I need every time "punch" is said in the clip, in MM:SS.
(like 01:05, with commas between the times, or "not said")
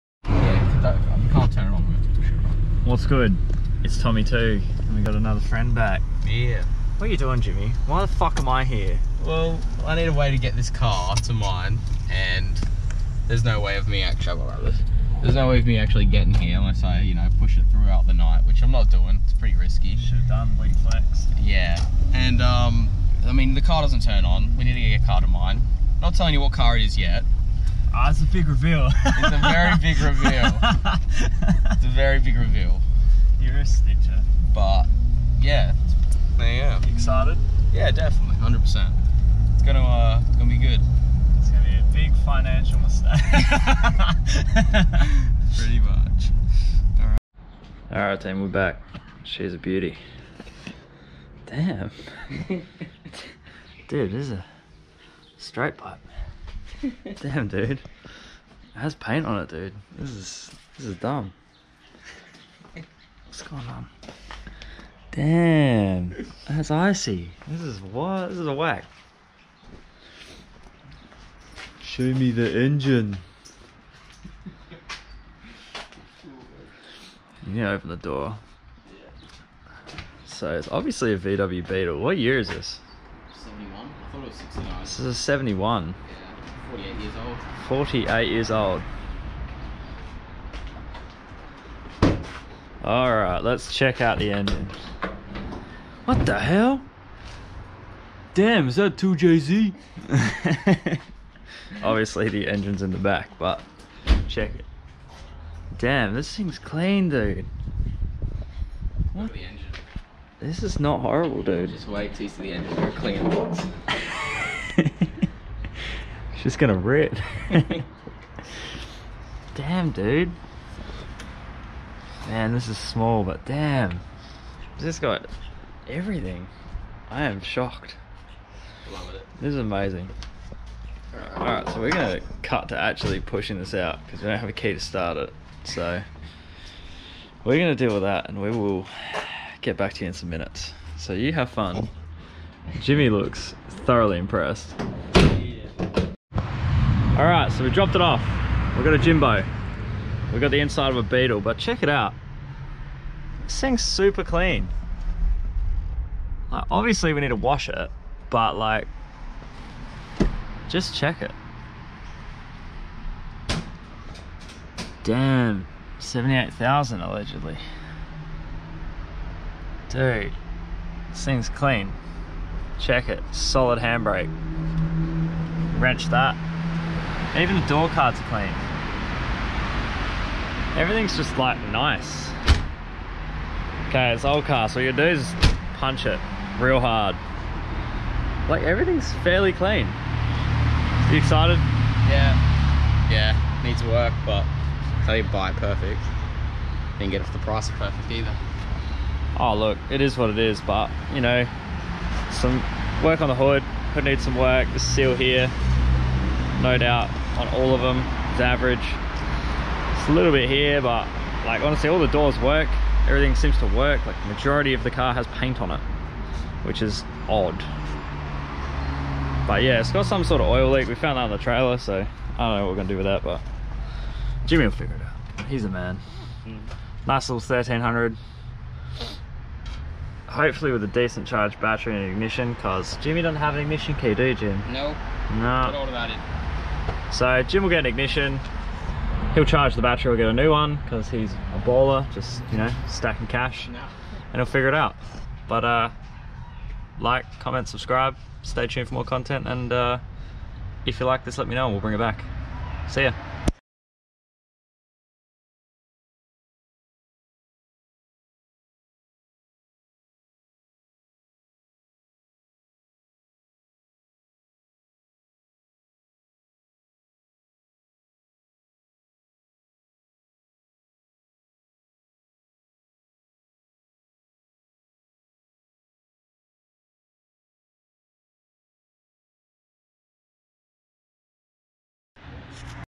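03:05.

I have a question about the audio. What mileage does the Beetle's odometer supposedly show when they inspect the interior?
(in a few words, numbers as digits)
78,000.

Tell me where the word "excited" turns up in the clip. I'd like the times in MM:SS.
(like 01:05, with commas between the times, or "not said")
00:36, 03:11.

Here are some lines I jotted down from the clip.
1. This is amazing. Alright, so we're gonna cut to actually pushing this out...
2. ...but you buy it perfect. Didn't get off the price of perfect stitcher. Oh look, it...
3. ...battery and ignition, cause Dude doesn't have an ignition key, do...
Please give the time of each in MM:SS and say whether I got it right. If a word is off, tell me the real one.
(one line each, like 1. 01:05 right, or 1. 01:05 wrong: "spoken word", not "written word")
1. 02:09 right
2. 03:14 wrong: "either", not "stitcher"
3. 03:51 wrong: "Jimmy", not "Dude".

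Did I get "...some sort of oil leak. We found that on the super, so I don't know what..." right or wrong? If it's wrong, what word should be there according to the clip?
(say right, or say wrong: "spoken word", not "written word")
wrong: "trailer", not "super".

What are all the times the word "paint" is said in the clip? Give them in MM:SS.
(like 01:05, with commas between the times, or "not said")
00:58, 03:35.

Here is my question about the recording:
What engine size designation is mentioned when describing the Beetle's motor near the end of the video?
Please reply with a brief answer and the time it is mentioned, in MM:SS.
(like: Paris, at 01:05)
1300, at 03:47.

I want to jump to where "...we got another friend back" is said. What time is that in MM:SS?
00:04.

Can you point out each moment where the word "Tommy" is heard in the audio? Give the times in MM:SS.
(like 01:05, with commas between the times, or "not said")
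00:04.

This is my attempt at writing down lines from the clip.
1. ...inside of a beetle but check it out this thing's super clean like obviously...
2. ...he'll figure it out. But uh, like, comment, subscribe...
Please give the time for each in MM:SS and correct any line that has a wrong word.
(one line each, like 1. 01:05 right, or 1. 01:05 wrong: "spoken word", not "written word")
1. 02:30 right
2. 04:04 right.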